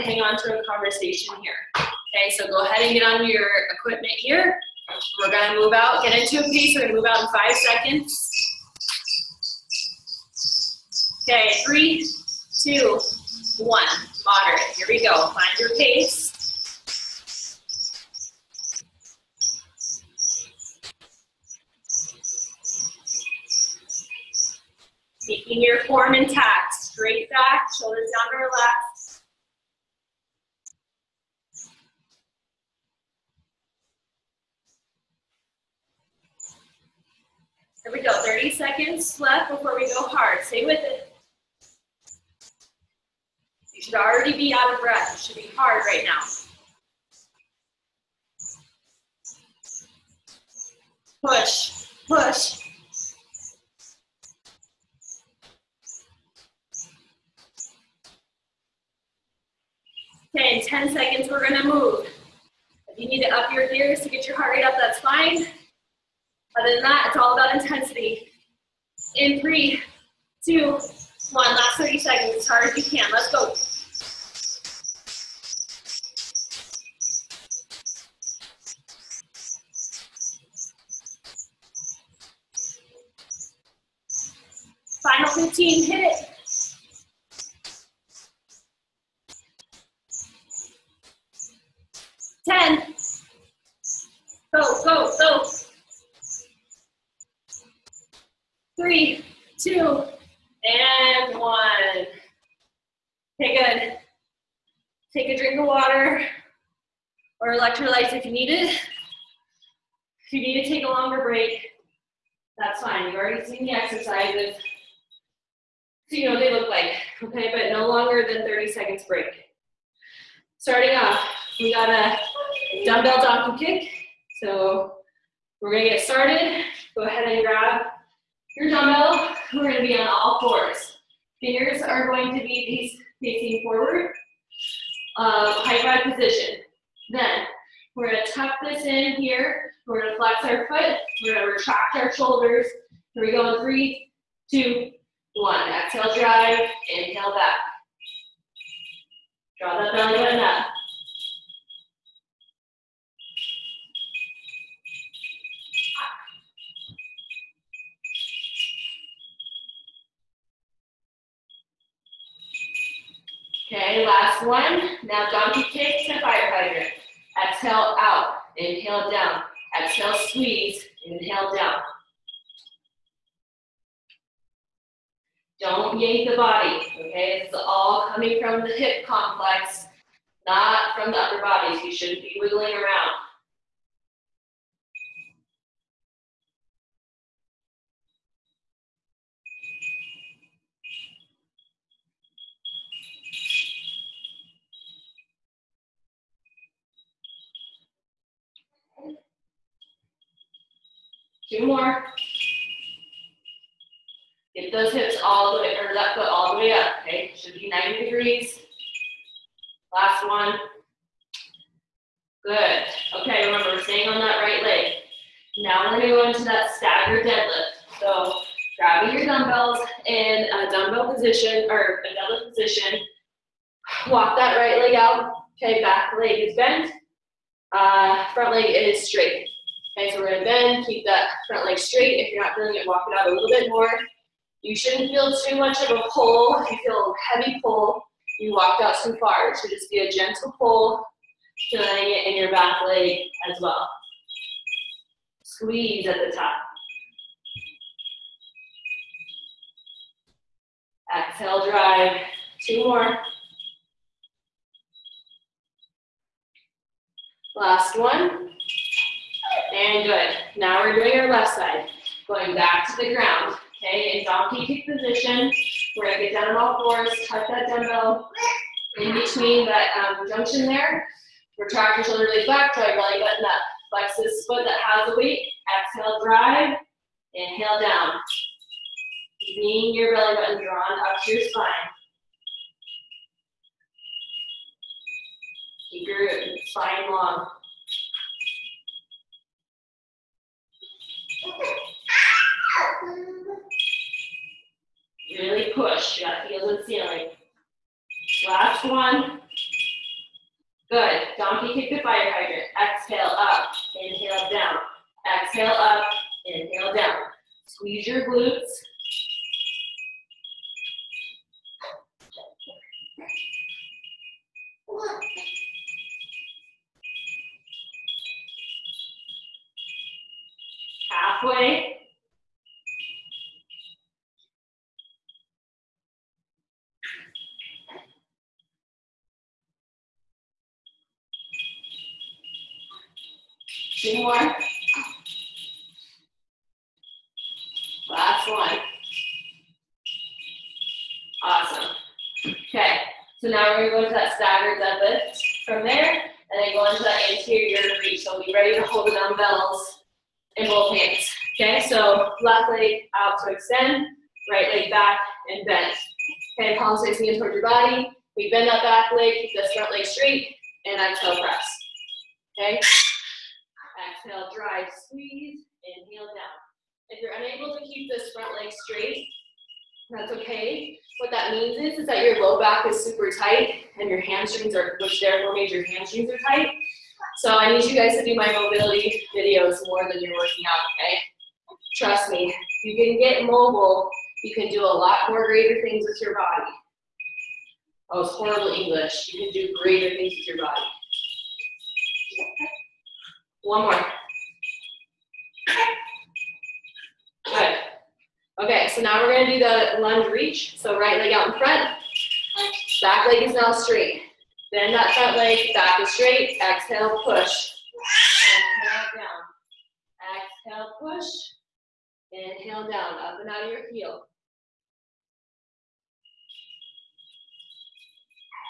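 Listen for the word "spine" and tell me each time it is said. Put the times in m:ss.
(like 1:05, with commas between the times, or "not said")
4:41, 4:46.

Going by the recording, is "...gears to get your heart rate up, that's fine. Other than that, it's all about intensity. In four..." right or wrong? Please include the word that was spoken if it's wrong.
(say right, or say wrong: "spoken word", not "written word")
wrong: "three", not "four".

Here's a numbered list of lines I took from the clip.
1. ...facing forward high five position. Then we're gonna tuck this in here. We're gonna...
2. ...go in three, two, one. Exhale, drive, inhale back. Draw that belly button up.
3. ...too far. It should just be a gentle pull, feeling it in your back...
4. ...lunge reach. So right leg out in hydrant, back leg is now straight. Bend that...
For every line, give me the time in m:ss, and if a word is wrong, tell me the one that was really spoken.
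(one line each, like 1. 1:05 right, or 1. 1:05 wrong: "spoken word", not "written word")
1. 2:13 right
2. 2:23 right
3. 3:59 right
4. 6:40 wrong: "front", not "hydrant".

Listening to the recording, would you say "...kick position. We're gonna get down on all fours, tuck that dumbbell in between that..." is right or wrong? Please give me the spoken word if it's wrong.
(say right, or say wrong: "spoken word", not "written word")
right.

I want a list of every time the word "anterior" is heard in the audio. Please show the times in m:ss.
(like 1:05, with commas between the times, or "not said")
5:47.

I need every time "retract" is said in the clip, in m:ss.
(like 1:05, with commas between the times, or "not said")
2:21, 4:31.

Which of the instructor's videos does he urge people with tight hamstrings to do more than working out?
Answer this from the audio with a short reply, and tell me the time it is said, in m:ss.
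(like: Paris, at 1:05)
mobility videos, at 6:18.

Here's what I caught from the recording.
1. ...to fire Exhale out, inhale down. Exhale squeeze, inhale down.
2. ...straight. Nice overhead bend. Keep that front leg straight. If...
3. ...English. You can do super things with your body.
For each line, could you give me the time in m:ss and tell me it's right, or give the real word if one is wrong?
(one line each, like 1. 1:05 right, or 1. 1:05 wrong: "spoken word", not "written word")
1. 2:46 right
2. 3:49 right
3. 6:28 wrong: "greater", not "super".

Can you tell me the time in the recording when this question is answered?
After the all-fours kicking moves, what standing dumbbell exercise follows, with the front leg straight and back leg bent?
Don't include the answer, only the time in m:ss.
3:36.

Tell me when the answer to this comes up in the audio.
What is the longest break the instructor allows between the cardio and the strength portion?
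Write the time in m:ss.
1:57.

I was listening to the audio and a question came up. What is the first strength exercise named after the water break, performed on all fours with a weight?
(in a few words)
dumbbell donkey kick.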